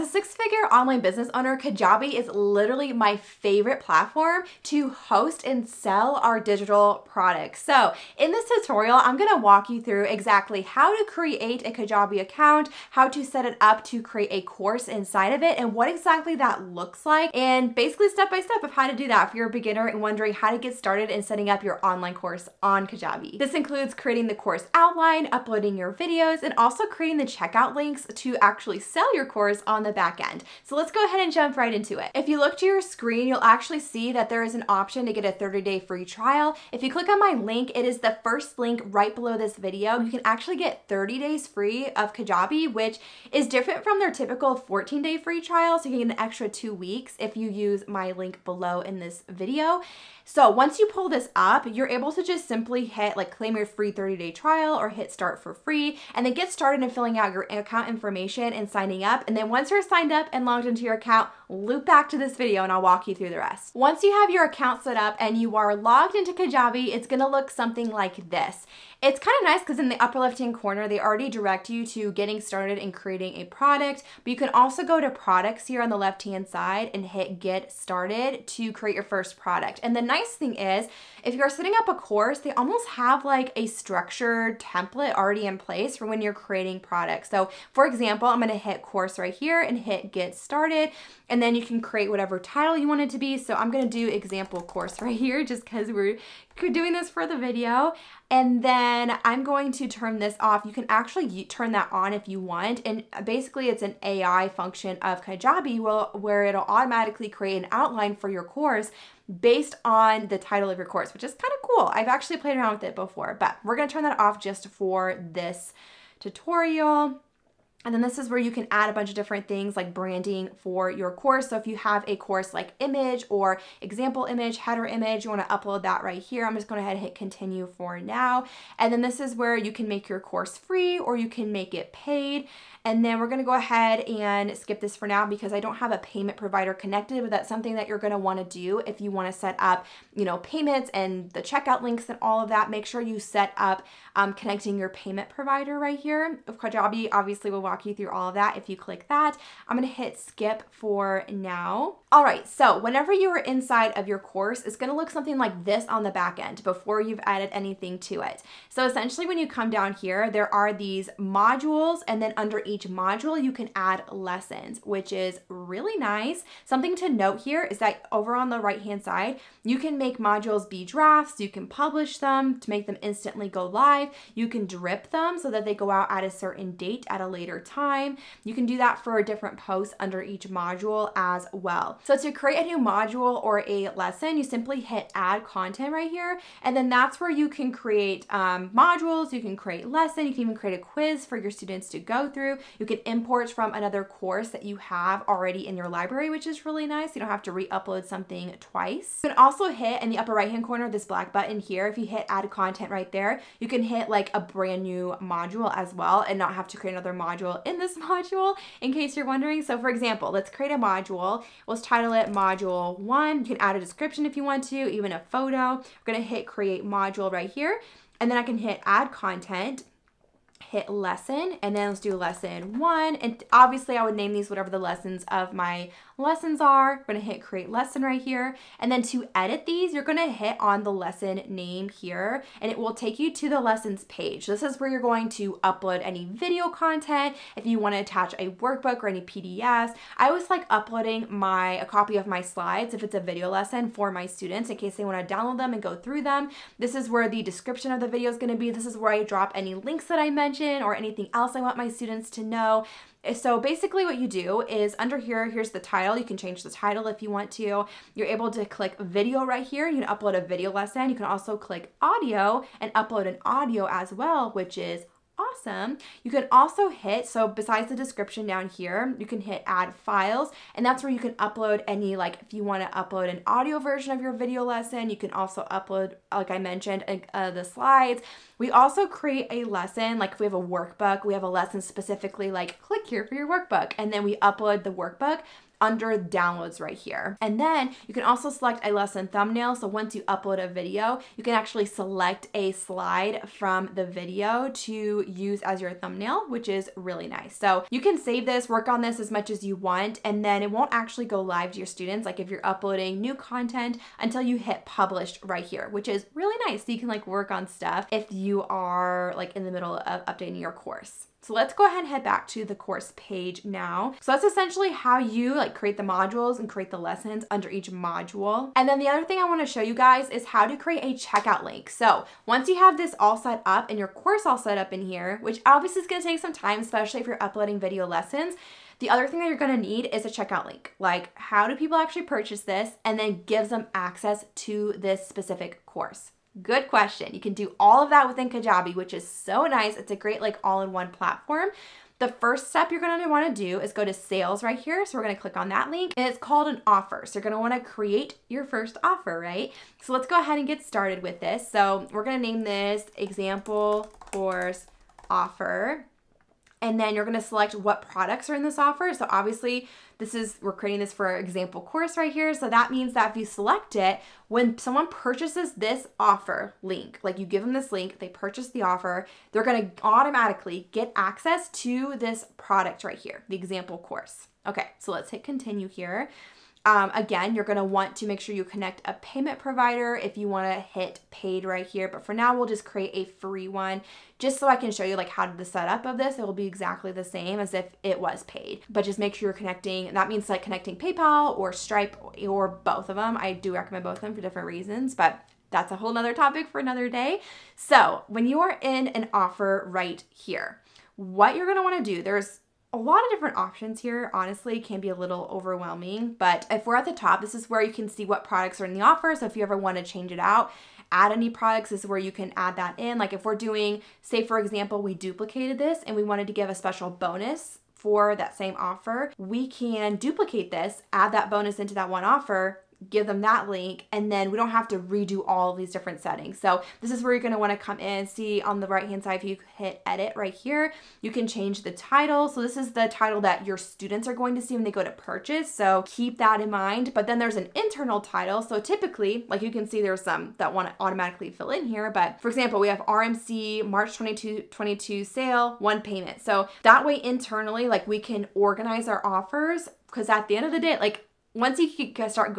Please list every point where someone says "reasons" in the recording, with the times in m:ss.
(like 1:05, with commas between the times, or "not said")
6:34.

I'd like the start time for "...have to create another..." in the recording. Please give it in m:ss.
3:26.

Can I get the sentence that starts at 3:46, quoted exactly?
We're gonna hit create lesson right here.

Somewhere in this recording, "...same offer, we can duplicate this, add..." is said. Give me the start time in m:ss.
6:58.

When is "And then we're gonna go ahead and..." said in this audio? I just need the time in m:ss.
2:12.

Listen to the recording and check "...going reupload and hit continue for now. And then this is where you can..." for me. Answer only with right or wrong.
wrong.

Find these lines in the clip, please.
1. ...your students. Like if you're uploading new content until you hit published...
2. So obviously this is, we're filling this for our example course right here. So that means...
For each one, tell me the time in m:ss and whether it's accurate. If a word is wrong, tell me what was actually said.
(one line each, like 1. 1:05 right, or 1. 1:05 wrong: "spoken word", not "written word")
1. 5:01 right
2. 5:59 wrong: "creating", not "filling".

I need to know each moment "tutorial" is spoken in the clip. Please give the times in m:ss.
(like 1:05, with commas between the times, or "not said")
0:08, 1:56.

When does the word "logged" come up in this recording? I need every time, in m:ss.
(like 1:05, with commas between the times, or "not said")
1:00, 1:05.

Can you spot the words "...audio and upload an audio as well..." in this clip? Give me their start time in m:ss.
4:22.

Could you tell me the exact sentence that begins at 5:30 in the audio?
Like how do people actually purchase this and then gives them access to this specific course.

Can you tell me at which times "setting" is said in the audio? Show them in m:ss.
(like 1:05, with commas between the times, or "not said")
0:21, 1:21, 7:06.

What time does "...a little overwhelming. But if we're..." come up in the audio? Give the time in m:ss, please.
6:45.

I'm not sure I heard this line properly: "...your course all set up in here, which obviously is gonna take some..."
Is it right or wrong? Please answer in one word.
right.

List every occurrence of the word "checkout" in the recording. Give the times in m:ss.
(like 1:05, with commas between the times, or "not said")
0:27, 2:21, 5:21, 5:30.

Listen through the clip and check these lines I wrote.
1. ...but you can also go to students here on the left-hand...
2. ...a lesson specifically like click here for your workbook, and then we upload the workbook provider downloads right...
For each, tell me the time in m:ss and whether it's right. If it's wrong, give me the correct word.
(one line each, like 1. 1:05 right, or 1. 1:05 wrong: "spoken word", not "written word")
1. 1:14 wrong: "products", not "students"
2. 4:41 wrong: "under", not "provider".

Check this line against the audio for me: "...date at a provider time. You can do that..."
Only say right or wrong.
wrong.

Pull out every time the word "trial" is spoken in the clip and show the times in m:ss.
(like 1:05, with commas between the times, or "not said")
0:36, 0:45, 0:54.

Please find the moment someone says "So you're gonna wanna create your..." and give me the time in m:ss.
5:47.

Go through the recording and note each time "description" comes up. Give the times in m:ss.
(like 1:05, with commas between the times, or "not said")
3:33, 4:07, 4:27.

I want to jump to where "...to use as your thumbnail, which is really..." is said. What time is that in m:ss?
4:54.